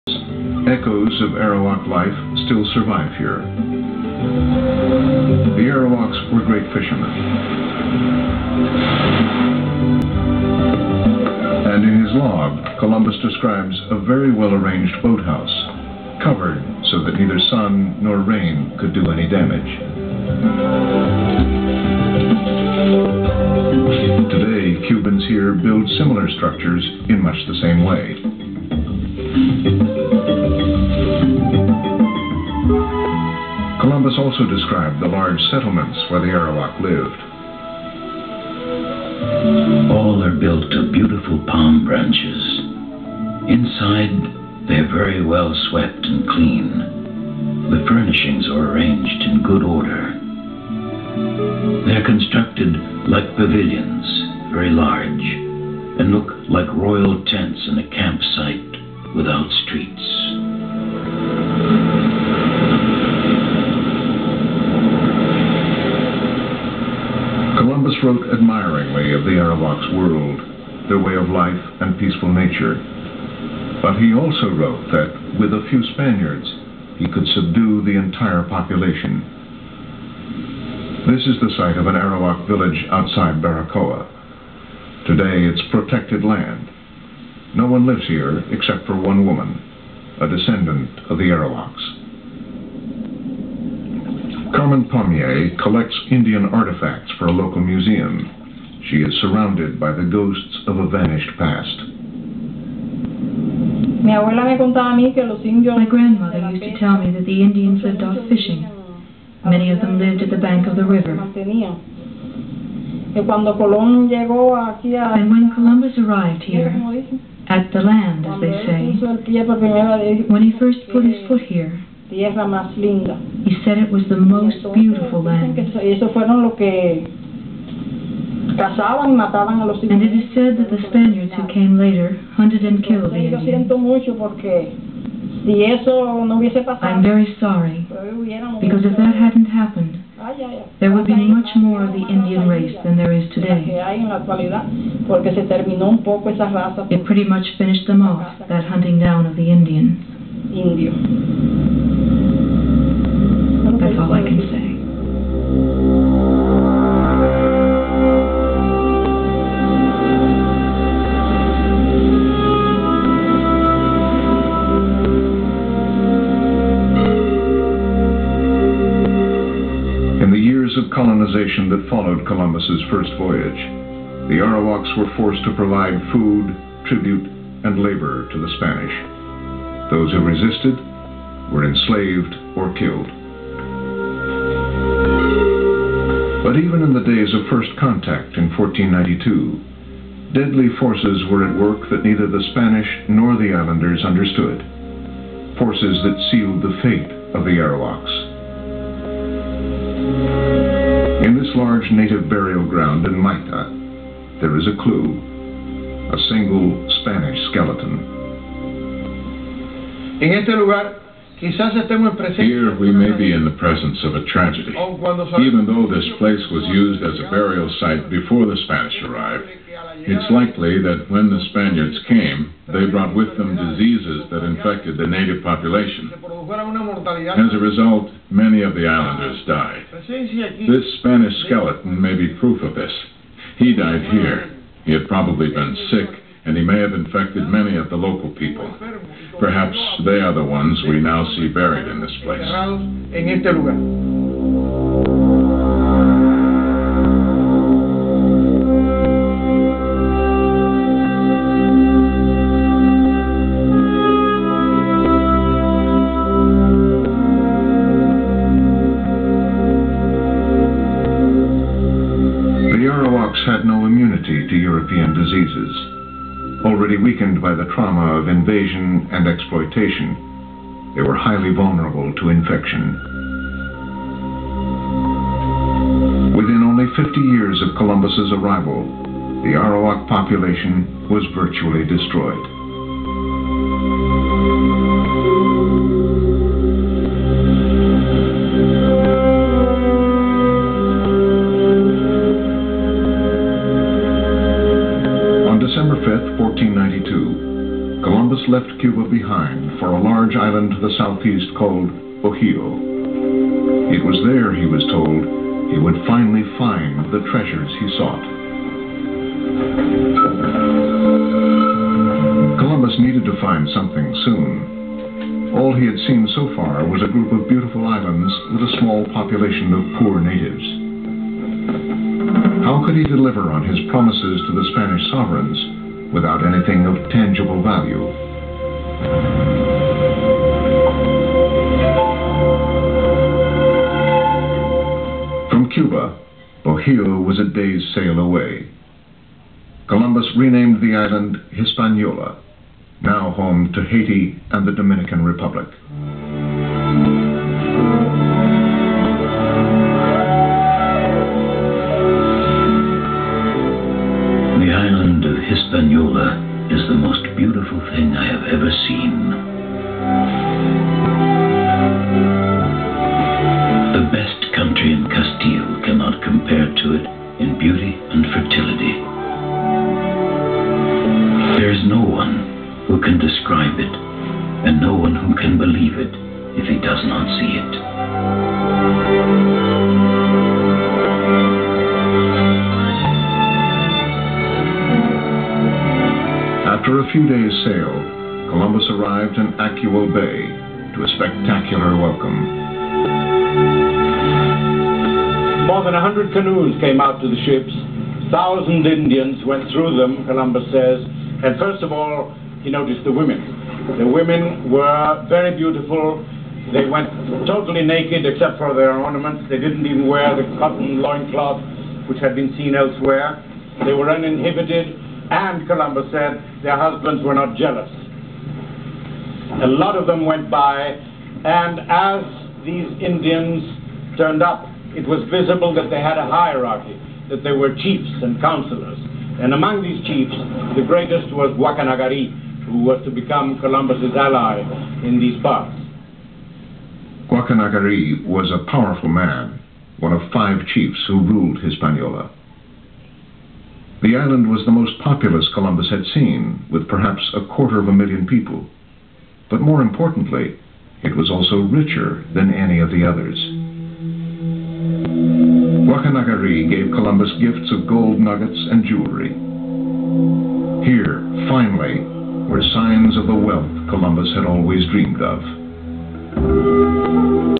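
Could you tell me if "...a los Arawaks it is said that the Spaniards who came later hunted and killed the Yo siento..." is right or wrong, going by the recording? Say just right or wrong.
wrong.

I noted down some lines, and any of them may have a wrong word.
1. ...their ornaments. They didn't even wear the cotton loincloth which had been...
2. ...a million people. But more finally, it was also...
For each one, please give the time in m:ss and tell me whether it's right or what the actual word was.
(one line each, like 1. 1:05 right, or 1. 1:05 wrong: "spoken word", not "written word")
1. 6:48 right
2. 7:27 wrong: "importantly", not "finally".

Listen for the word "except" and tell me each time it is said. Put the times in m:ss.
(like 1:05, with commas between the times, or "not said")
1:28, 6:48.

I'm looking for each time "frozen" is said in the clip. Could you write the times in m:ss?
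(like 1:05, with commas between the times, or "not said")
not said.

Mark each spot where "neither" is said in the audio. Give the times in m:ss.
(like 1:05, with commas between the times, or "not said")
0:17, 3:12.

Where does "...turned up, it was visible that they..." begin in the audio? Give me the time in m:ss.
7:04.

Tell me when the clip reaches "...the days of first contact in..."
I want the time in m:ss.
3:06.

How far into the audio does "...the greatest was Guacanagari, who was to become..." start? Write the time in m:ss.
7:10.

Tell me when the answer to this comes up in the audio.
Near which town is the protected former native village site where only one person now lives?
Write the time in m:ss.
1:23.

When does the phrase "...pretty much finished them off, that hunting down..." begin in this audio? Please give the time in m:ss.
2:27.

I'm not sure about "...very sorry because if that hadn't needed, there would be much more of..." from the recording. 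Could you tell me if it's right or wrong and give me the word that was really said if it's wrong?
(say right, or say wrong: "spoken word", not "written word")
wrong: "happened", not "needed".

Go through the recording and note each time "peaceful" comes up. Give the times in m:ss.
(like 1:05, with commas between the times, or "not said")
1:11.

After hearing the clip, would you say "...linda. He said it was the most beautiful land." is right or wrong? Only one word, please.
right.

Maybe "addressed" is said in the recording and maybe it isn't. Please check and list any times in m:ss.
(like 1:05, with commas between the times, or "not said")
not said.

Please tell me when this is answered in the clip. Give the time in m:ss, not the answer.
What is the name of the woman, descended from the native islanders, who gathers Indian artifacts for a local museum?
1:34.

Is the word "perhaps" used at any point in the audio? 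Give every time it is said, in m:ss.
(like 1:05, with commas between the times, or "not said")
3:59, 7:26.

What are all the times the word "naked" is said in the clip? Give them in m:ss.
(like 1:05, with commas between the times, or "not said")
6:47.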